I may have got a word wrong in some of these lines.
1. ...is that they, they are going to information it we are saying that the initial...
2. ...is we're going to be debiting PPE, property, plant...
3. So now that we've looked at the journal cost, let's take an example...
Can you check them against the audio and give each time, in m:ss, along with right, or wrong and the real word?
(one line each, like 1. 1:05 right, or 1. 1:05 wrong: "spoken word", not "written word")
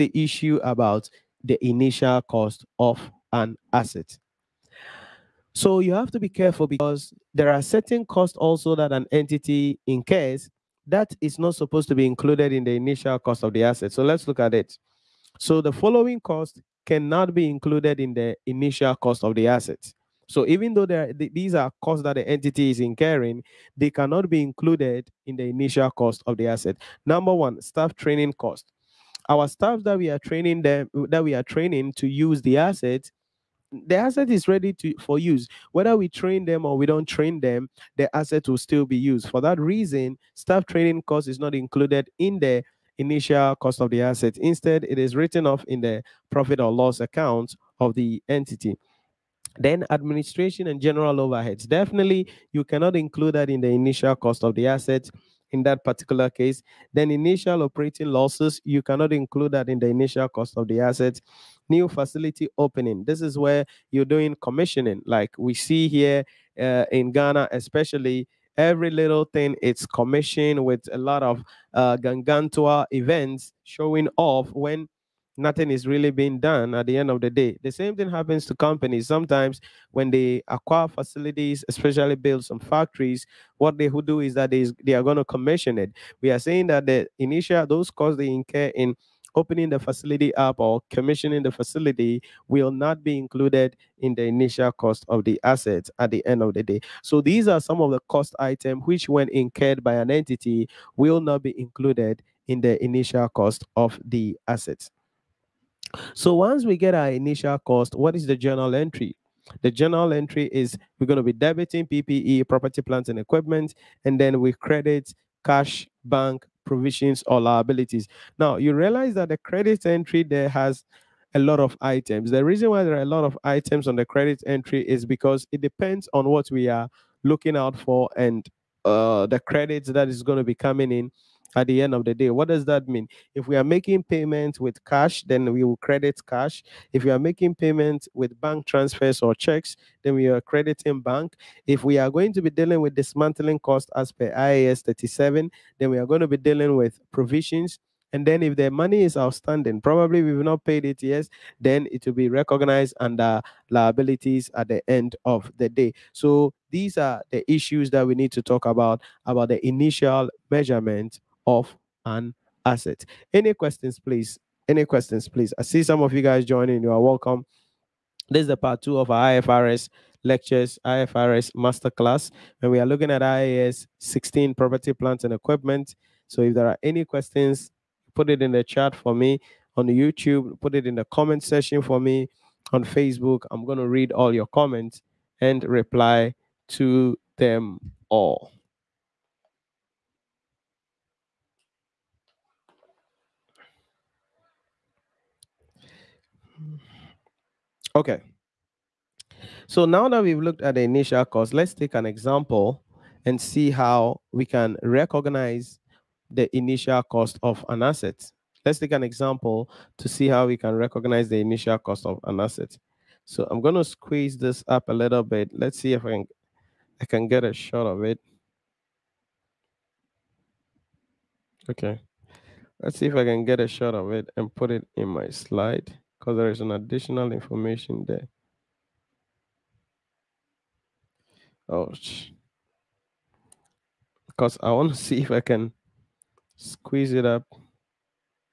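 1. 1:24 wrong: "commission", not "information"
2. 1:50 right
3. 3:19 wrong: "initial", not "journal".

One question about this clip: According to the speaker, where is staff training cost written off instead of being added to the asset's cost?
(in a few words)
profit or loss account.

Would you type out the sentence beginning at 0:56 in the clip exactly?
Then initial operating losses, you cannot include that in the initial cost of the asset.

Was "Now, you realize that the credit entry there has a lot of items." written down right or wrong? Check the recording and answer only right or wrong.
right.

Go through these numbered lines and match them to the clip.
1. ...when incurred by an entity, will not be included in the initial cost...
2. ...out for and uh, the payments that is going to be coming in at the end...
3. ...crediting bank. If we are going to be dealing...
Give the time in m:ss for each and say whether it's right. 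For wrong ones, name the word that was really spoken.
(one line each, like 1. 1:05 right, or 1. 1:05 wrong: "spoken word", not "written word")
1. 1:39 right
2. 2:07 wrong: "credits", not "payments"
3. 2:20 right.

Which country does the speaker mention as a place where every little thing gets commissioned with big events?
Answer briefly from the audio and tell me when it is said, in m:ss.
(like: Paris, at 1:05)
Ghana, at 1:07.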